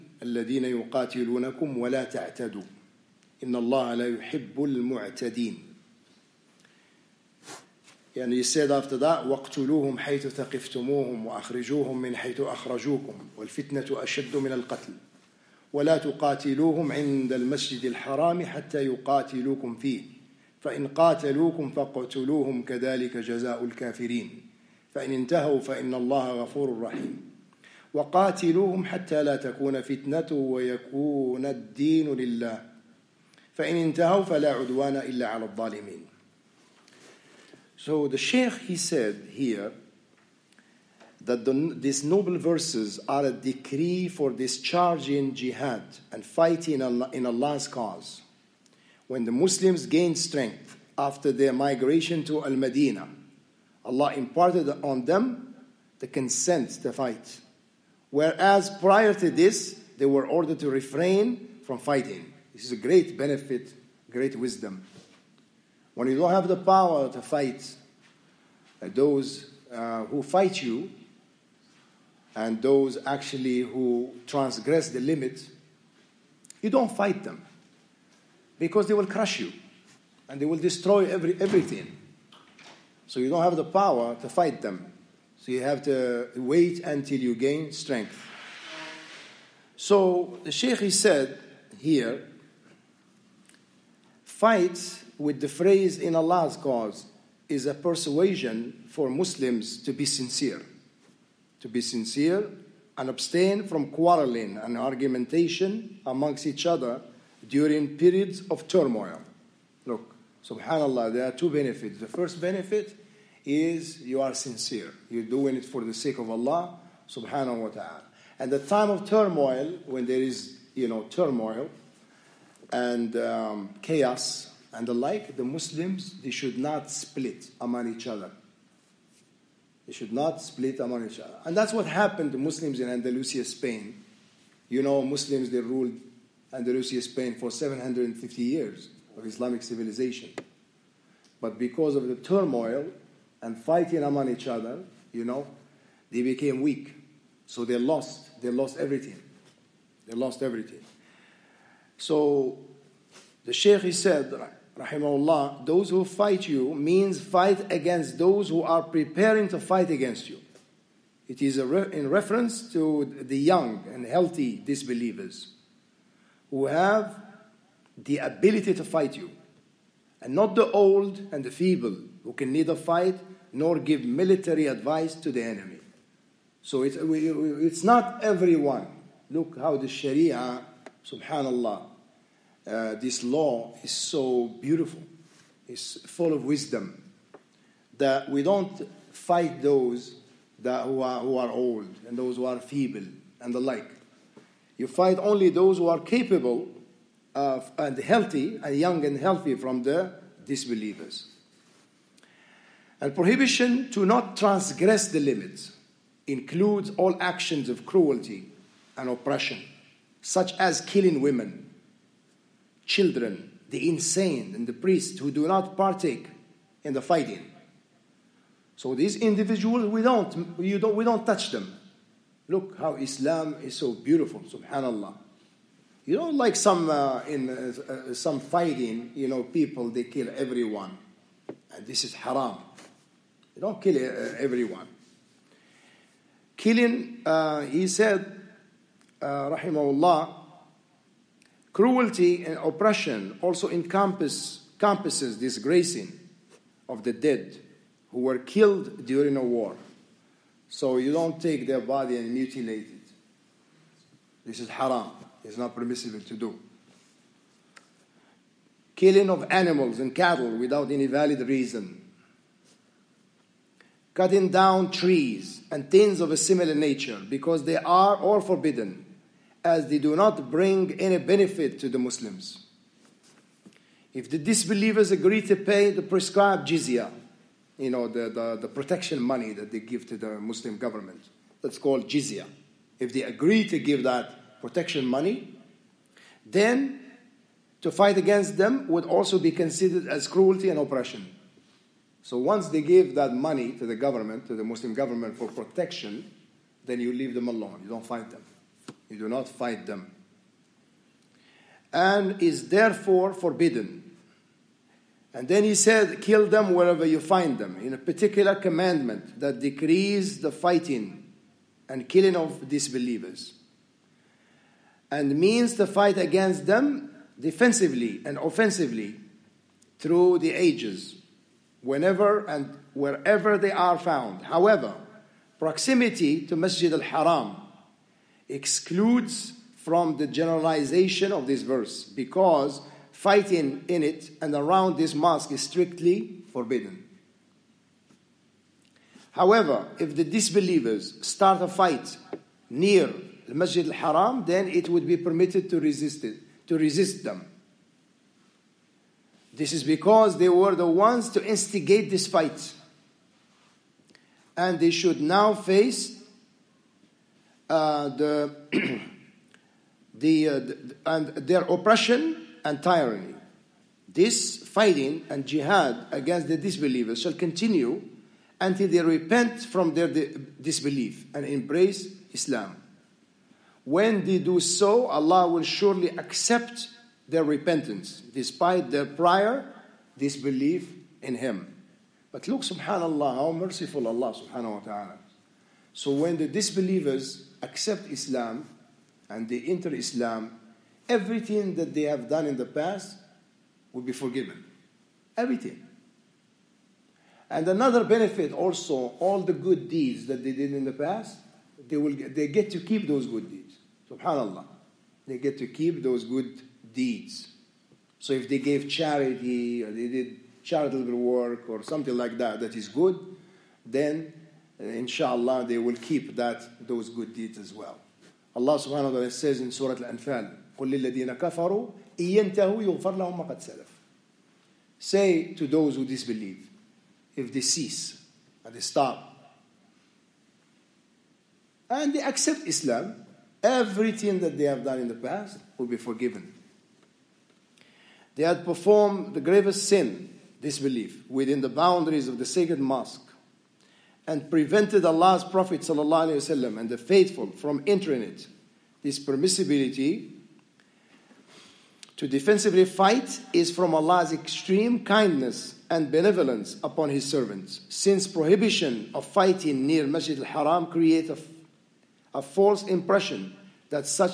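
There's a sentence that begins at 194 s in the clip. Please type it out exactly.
You fight only those who are capable of, and healthy and young and healthy from the disbelievers.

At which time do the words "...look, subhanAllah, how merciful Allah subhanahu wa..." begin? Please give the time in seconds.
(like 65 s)
382 s.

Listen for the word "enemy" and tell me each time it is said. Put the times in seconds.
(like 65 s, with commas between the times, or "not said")
175 s.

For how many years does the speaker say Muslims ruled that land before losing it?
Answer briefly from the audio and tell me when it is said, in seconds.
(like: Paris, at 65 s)
750, at 137 s.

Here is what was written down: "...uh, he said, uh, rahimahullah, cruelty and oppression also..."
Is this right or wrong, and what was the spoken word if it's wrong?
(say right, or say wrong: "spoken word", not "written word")
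right.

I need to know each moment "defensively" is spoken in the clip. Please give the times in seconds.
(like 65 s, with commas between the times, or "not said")
317 s, 452 s.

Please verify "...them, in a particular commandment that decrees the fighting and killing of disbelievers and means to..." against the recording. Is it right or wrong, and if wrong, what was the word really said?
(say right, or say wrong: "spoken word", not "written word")
right.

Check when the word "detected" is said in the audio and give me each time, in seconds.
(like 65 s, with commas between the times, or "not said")
not said.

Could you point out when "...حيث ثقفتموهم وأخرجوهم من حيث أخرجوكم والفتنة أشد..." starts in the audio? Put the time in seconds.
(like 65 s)
9 s.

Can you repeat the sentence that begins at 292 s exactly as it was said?
So once they give that money to the government, to the Muslim government for protection, then you leave them alone.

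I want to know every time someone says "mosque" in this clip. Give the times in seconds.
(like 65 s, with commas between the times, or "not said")
335 s, 442 s.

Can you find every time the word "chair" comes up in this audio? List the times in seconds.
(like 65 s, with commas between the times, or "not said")
not said.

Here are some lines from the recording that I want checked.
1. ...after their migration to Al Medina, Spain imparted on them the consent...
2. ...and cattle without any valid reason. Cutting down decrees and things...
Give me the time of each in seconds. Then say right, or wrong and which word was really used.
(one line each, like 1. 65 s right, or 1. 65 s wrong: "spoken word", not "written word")
1. 50 s wrong: "Allah", not "Spain"
2. 259 s wrong: "trees", not "decrees".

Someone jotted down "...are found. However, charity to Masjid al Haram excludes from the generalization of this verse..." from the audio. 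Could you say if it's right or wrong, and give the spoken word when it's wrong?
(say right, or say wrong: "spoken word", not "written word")
wrong: "proximity", not "charity".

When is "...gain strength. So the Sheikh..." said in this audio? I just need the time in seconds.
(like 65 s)
87 s.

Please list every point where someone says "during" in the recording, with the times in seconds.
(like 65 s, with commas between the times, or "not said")
107 s, 249 s.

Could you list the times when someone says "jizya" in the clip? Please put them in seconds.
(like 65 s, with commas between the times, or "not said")
276 s, 282 s.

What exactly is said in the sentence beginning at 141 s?
But because of the turmoil and fighting among each other, you know, they became weak.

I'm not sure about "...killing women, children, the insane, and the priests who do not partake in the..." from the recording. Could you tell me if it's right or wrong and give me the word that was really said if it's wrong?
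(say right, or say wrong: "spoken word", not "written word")
right.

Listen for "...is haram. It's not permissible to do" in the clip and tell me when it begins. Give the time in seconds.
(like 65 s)
254 s.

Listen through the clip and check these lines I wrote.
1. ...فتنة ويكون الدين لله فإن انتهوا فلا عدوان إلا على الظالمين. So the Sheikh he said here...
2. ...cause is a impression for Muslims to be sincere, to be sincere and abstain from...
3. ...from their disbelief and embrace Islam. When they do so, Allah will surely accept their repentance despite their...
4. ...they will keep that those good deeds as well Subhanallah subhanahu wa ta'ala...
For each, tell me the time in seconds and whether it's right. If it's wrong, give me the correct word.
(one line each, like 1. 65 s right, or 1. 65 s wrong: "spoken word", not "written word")
1. 29 s right
2. 96 s wrong: "persuasion", not "impression"
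3. 369 s right
4. 415 s wrong: "Allah", not "Subhanallah".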